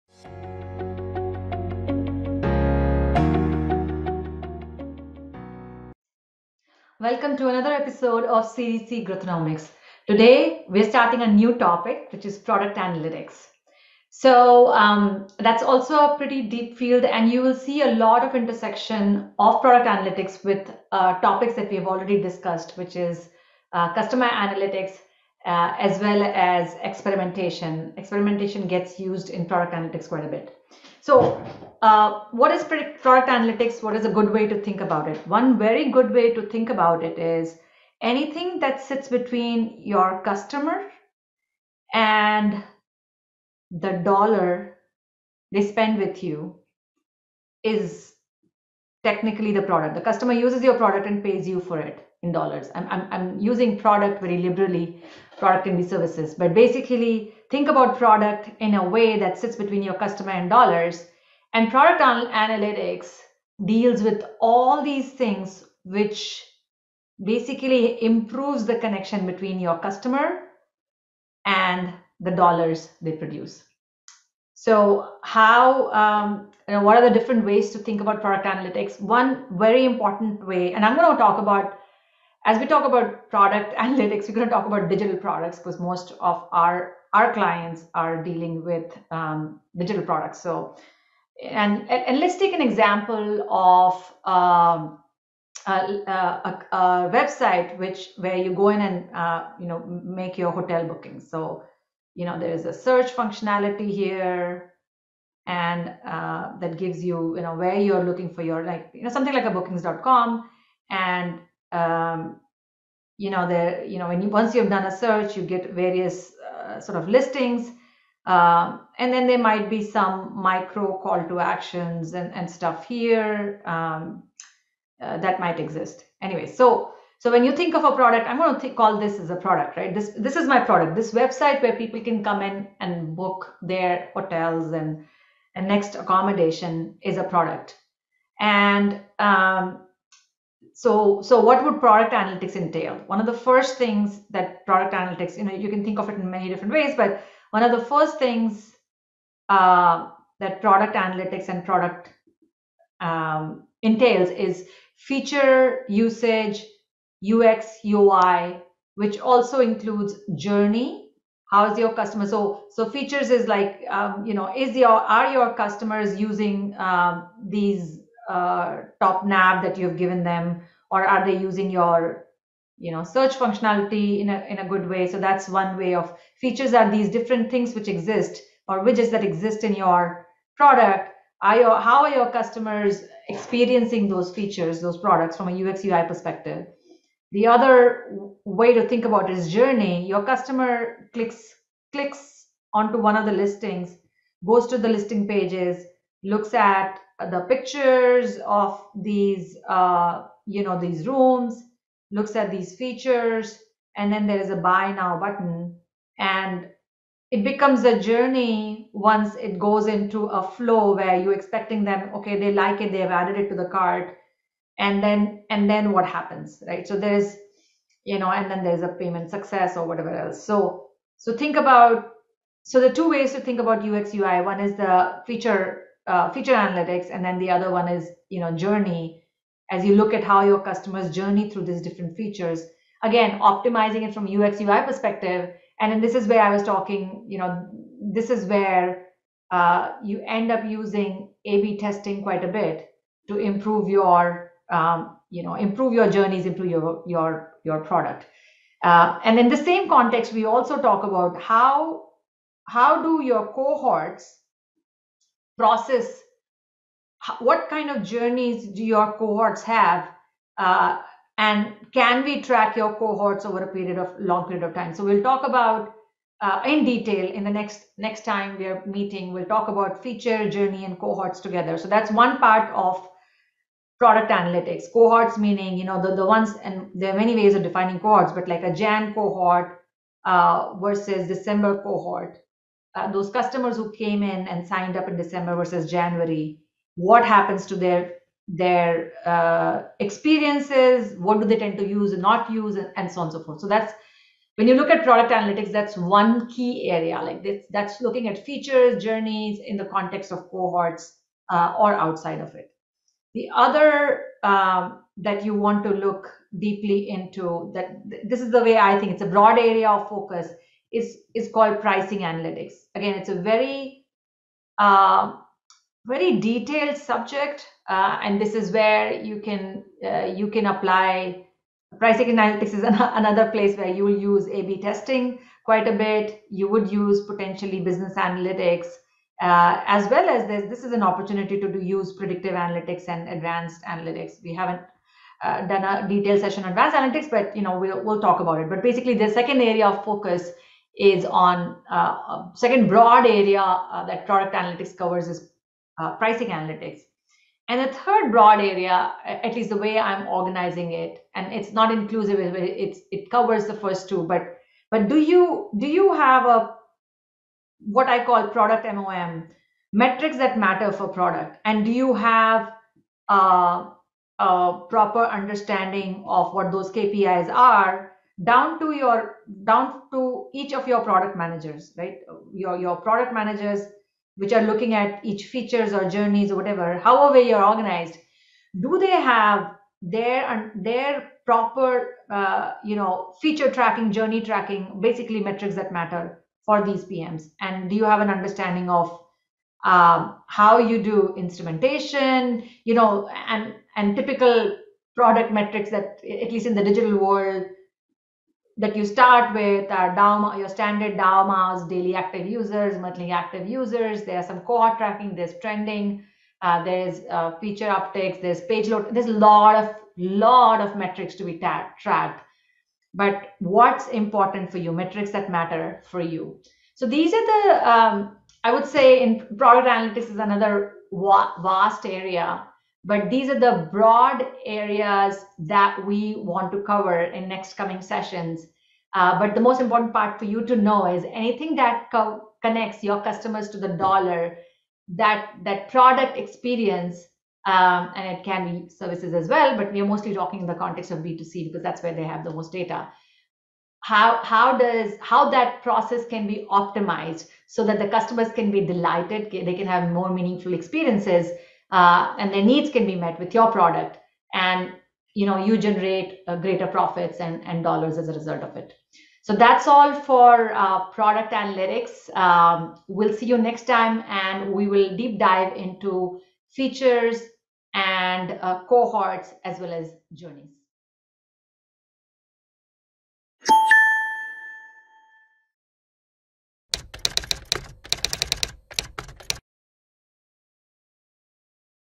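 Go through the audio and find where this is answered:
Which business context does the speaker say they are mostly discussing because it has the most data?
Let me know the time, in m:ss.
7:21.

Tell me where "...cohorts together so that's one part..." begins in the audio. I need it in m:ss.
4:30.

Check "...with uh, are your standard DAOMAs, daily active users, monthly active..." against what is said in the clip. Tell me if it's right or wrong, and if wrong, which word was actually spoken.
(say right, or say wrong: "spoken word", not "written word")
right.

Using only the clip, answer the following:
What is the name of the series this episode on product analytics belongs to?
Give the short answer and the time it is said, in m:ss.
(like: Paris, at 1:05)
Series C Growthonomics, at 0:08.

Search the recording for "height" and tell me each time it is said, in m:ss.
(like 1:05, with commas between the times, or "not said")
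not said.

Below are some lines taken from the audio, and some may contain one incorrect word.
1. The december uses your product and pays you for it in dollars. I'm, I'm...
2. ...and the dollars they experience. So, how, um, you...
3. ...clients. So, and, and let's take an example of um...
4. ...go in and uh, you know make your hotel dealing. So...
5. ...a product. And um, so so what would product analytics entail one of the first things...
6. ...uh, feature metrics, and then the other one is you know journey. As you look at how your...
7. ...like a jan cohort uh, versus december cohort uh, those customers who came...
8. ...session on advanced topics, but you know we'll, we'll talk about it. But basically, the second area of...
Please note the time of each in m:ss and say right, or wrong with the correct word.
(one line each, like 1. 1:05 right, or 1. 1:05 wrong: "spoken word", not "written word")
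1. 0:49 wrong: "customer", not "december"
2. 1:11 wrong: "produce", not "experience"
3. 1:30 wrong: "products", not "clients"
4. 1:38 wrong: "booking", not "dealing"
5. 2:17 right
6. 3:46 wrong: "analytics", not "metrics"
7. 4:38 right
8. 5:36 wrong: "analytics", not "topics".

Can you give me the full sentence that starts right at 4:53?
So that's when you look at product analytics, that's one key area.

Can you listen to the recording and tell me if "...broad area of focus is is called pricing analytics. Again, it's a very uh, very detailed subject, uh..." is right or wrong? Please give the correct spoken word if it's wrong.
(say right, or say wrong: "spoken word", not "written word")
right.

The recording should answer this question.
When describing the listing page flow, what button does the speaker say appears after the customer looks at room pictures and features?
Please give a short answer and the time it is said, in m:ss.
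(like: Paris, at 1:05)
Buy now, at 3:24.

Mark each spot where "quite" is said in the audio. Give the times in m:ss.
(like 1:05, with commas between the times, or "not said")
0:30, 4:02, 5:25.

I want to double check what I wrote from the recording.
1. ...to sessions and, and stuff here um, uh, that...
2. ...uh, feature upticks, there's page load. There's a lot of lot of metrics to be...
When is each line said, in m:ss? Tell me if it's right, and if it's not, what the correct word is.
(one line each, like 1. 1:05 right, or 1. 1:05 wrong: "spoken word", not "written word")
1. 2:01 wrong: "actions", not "sessions"
2. 6:47 right.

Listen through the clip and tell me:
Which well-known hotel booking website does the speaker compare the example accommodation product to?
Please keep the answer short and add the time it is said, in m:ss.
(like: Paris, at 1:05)
bookings.com, at 1:49.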